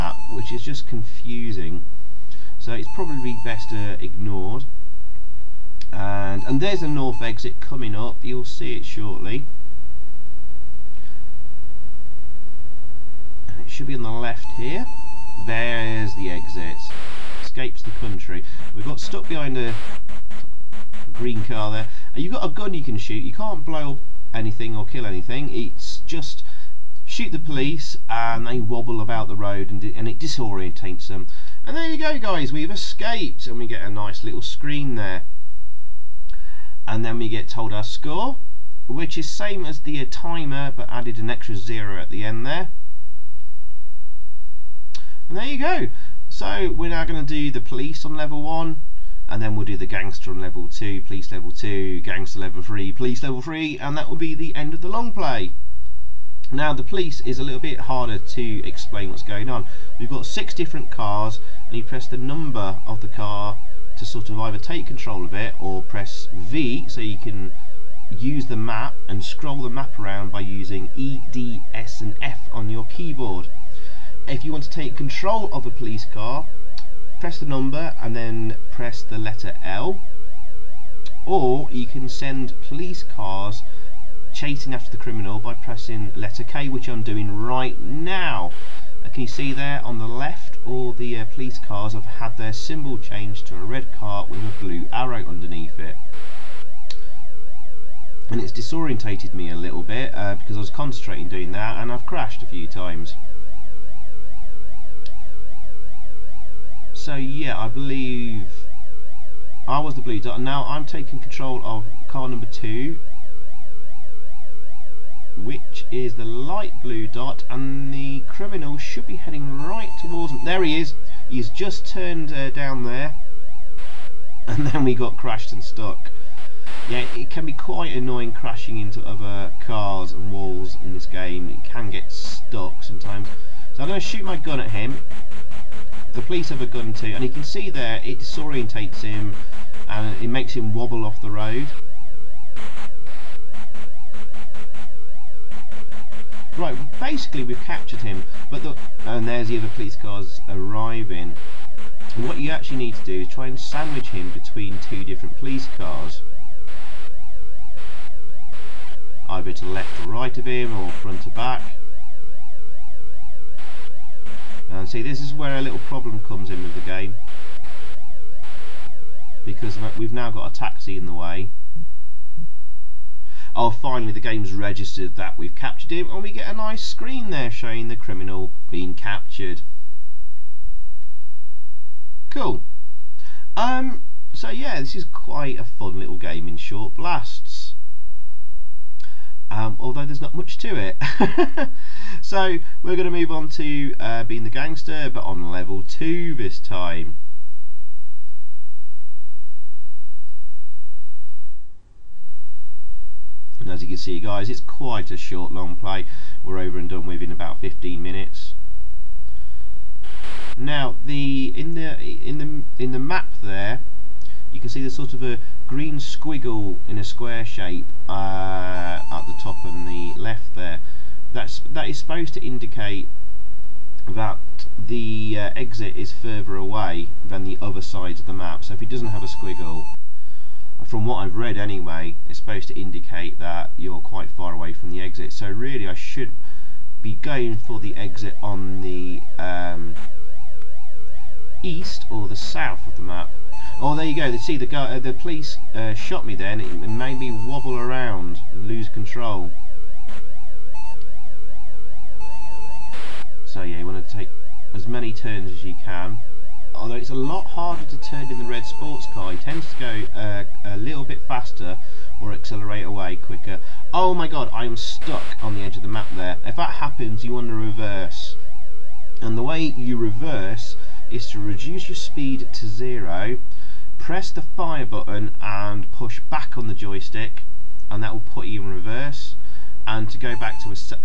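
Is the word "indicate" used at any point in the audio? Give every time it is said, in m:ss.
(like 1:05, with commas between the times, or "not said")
3:42, 3:52.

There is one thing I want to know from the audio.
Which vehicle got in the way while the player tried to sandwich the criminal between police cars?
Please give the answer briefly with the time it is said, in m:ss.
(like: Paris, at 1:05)
A taxi, at 2:50.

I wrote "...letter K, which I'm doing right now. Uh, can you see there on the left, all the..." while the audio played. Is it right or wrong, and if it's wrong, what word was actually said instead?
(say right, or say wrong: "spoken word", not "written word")
right.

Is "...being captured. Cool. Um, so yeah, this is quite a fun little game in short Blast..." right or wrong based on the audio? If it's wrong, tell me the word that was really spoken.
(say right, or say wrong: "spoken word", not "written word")
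right.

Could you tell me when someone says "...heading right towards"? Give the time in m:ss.
1:59.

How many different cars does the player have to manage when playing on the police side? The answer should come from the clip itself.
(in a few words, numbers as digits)
6.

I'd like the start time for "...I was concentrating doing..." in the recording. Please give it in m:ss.
1:40.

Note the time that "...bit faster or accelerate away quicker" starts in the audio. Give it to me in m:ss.
4:21.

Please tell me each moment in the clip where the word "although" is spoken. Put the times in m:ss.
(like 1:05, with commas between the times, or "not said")
3:09, 4:16.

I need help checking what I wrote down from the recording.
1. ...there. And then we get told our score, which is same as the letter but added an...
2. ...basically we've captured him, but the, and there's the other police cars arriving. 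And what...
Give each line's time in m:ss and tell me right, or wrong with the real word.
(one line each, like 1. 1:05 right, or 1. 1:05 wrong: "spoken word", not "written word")
1. 0:34 wrong: "timer", not "letter"
2. 2:26 right.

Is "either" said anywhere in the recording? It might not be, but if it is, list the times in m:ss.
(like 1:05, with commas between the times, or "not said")
1:04, 2:39.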